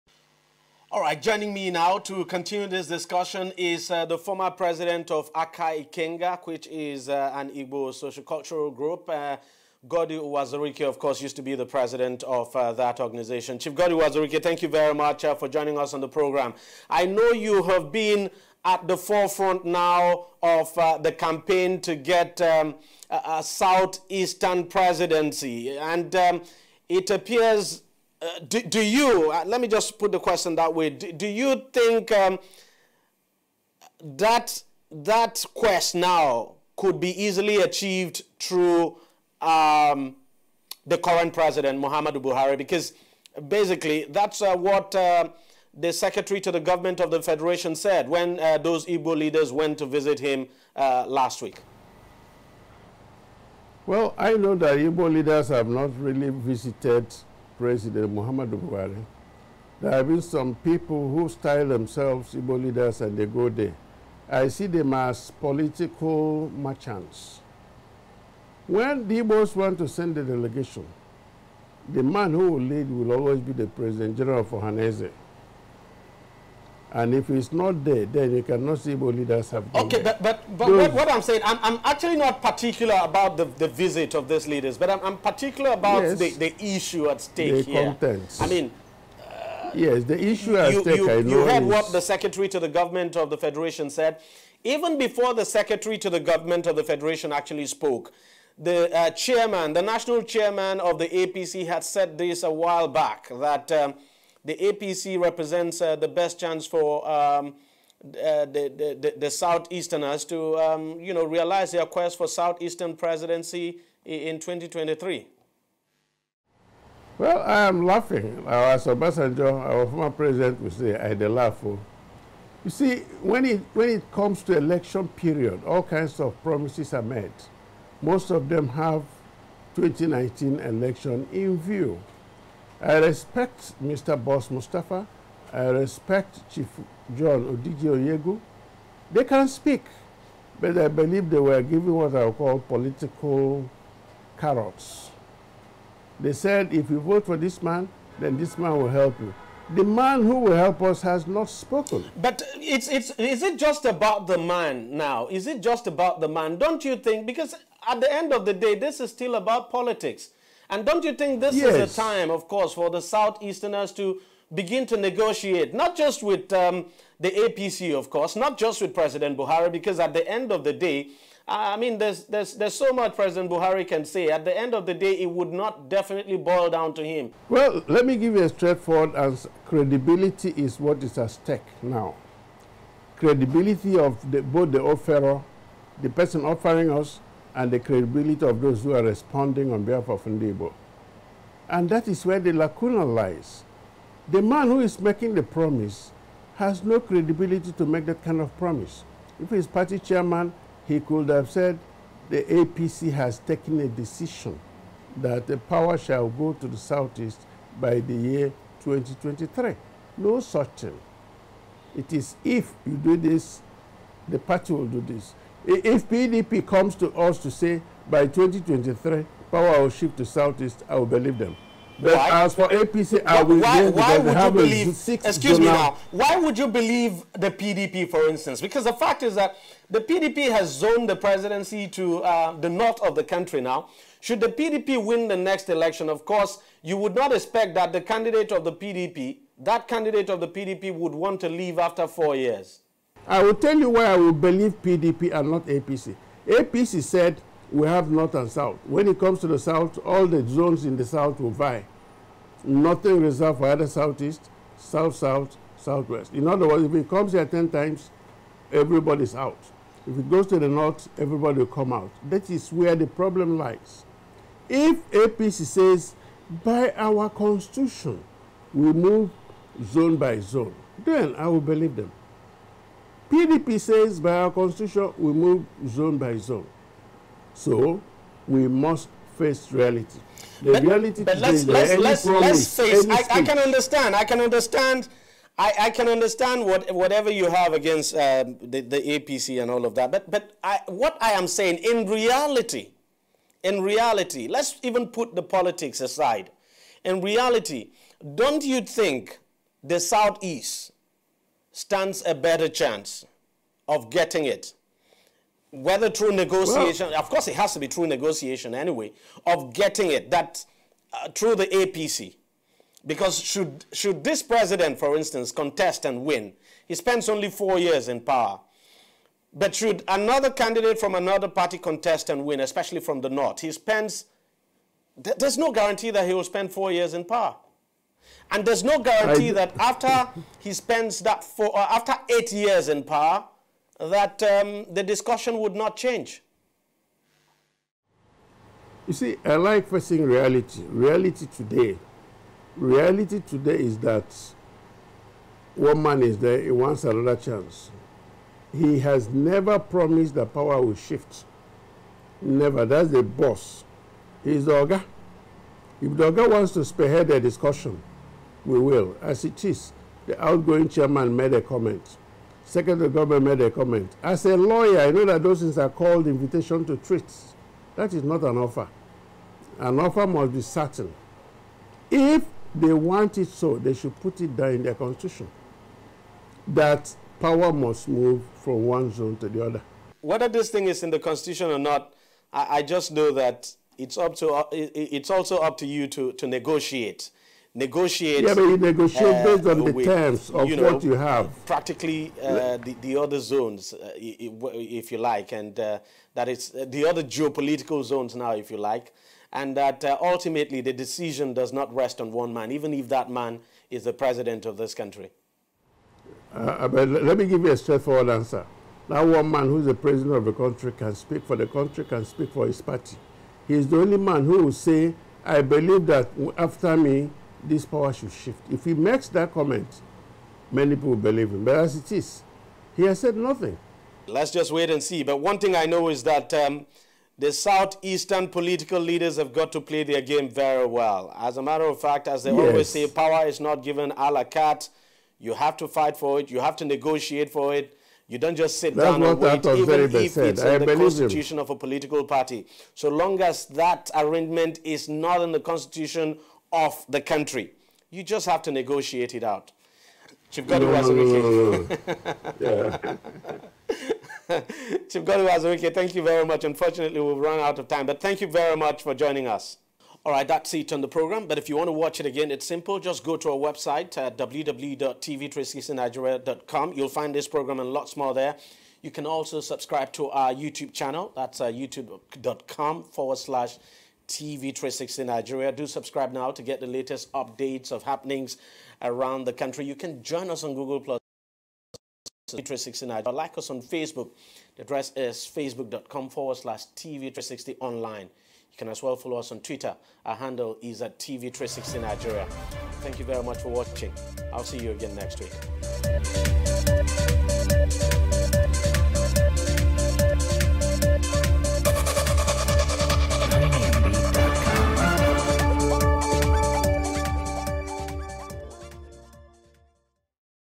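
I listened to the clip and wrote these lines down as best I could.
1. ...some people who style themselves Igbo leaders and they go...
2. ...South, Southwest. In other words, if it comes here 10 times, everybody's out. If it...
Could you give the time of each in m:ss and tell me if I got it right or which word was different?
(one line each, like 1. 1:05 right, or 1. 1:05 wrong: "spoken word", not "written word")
1. 1:00 right
2. 4:15 right.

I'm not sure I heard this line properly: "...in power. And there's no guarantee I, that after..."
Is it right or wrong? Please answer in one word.
right.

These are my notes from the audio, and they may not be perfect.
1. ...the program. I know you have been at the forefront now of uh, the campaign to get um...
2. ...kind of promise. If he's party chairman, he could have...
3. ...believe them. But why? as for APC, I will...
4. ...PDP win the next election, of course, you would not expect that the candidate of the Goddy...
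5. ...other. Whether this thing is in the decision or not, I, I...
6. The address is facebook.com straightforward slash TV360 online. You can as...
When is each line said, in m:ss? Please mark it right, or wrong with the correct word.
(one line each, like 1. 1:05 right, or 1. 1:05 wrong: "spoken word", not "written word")
1. 0:16 right
2. 3:18 right
3. 3:41 right
4. 3:54 wrong: "PDP", not "Goddy"
5. 6:19 wrong: "constitution", not "decision"
6. 8:04 wrong: "forward", not "straightforward".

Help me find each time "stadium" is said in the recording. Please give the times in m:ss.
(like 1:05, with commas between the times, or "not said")
not said.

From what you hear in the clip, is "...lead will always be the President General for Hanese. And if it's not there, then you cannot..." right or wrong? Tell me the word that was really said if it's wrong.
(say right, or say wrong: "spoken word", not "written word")
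right.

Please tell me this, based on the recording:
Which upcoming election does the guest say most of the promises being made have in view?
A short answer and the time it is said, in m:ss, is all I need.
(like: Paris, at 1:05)
2019, at 2:09.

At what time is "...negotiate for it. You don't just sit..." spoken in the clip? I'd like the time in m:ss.
7:16.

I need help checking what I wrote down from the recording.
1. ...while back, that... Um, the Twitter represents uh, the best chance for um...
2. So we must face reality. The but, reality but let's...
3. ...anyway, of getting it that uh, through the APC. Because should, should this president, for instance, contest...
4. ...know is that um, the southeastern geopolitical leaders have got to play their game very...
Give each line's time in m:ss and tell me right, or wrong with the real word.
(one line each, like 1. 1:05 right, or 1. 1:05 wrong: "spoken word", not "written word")
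1. 1:42 wrong: "APC", not "Twitter"
2. 4:37 right
3. 5:08 right
4. 7:05 wrong: "political", not "geopolitical".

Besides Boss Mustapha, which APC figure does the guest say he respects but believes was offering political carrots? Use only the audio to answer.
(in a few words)
John Odigie Oyegun.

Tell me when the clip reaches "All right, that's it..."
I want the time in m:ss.
7:40.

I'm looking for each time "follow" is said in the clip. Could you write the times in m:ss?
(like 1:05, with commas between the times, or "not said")
8:09.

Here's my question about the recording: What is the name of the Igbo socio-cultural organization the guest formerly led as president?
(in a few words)
Aka Ikenga.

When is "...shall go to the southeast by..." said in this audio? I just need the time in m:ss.
3:25.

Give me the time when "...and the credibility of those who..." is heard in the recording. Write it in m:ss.
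3:07.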